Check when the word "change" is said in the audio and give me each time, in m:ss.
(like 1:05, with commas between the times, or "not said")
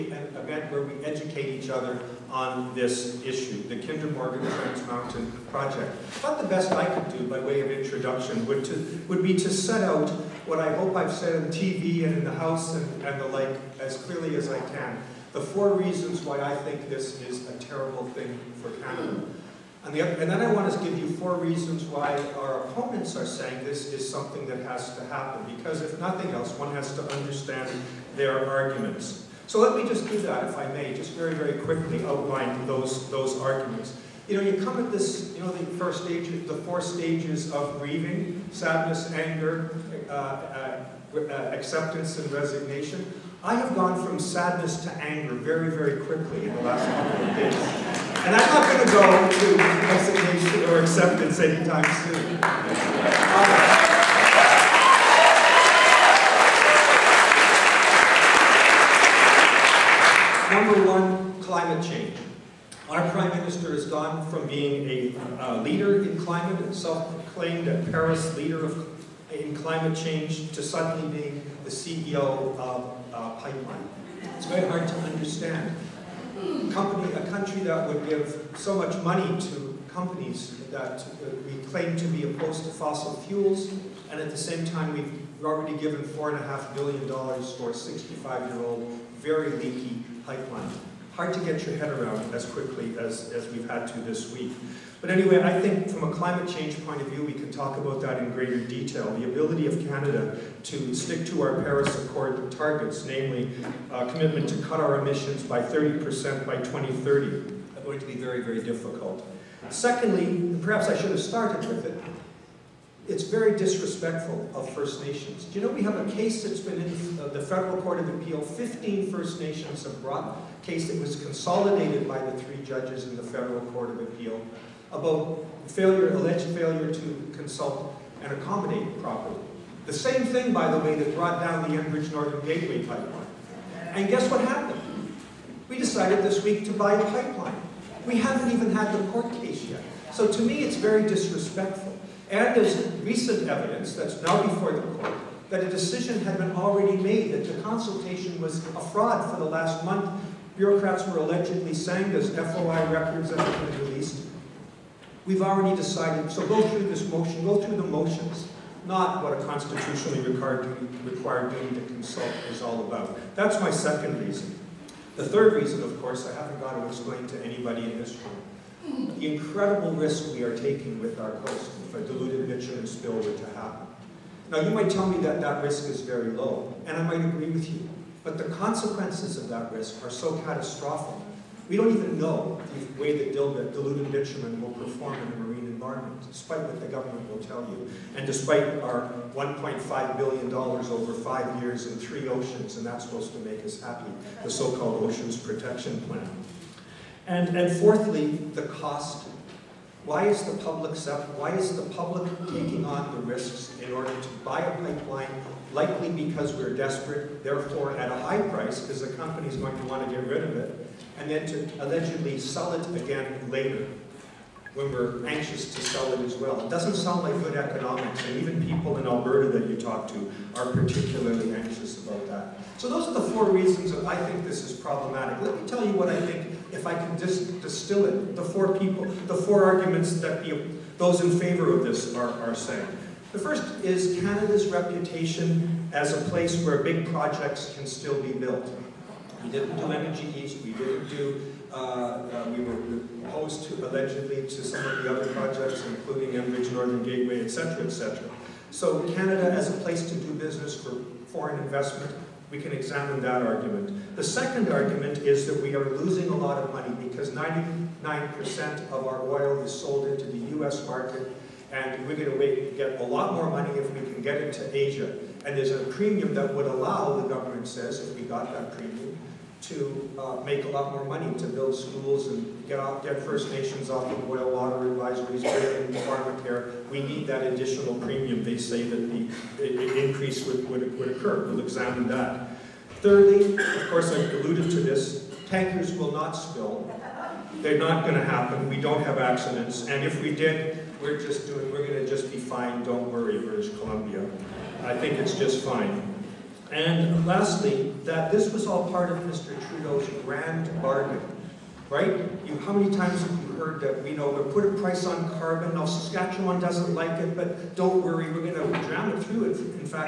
1:01, 1:09, 1:36.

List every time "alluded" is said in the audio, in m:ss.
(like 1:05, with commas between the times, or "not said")
4:44.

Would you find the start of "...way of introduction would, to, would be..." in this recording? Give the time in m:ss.
0:07.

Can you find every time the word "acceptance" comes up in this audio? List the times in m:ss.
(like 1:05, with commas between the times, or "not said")
0:41, 0:50.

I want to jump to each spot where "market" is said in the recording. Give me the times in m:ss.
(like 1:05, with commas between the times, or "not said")
4:20.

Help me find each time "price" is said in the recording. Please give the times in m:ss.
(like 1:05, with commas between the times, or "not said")
3:28, 5:04.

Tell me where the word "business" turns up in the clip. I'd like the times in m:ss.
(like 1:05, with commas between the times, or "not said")
4:10.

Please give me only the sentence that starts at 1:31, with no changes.
Hard to get your head around as quickly as, as we've had to this week.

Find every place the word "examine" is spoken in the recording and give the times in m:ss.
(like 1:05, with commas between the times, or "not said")
4:12, 4:41.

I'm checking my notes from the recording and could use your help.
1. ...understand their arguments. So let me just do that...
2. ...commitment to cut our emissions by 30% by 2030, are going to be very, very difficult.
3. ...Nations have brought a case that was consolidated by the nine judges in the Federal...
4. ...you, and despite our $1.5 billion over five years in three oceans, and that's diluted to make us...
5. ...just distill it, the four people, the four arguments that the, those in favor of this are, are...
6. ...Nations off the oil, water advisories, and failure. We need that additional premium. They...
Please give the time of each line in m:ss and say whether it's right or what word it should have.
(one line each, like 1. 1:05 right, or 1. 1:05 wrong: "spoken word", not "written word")
1. 0:27 right
2. 1:44 right
3. 1:59 wrong: "three", not "nine"
4. 3:07 wrong: "supposed", not "diluted"
5. 3:47 right
6. 4:33 wrong: "pharmacare", not "failure".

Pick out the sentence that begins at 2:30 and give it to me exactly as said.
Bureaucrats were allegedly saying there's FOI records that have been released.